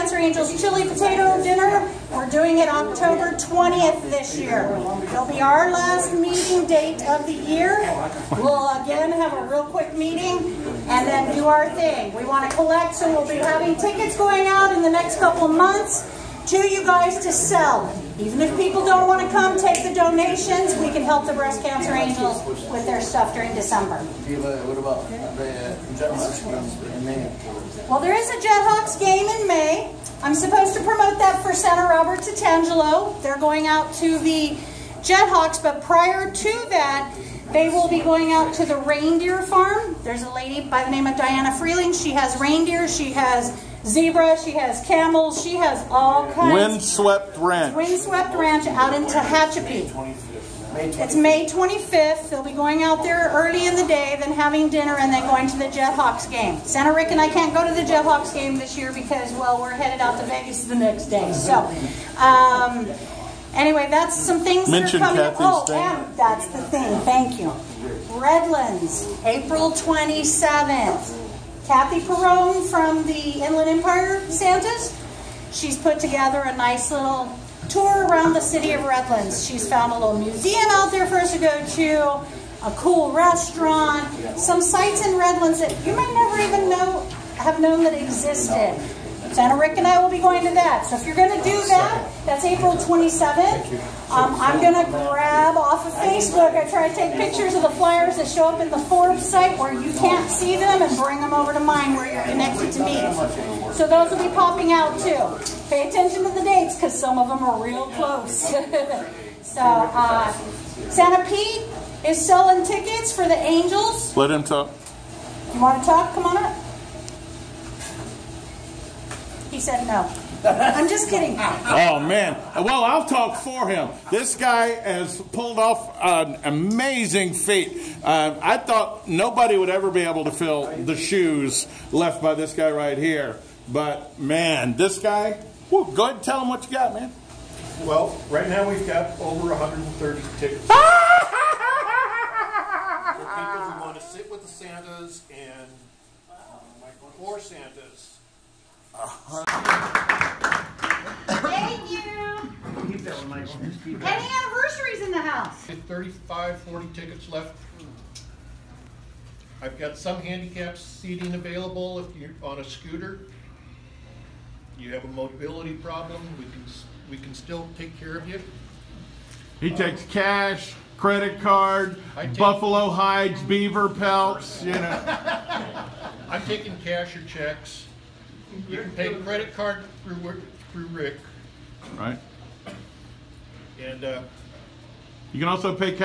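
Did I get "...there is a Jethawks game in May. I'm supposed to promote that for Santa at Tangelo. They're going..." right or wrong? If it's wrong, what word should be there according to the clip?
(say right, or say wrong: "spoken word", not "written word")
right.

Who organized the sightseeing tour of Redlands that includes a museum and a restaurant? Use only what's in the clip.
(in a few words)
Kathy Perone.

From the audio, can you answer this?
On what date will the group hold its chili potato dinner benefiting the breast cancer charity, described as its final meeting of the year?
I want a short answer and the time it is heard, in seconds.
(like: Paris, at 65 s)
October 20th, at 2 s.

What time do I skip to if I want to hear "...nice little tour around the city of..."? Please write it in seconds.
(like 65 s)
76 s.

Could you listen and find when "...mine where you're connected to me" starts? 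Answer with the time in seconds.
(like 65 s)
101 s.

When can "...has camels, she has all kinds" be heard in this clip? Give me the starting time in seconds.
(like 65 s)
44 s.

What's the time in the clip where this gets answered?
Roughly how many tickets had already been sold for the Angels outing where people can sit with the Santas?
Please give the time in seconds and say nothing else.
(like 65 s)
139 s.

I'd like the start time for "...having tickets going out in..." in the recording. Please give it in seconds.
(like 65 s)
13 s.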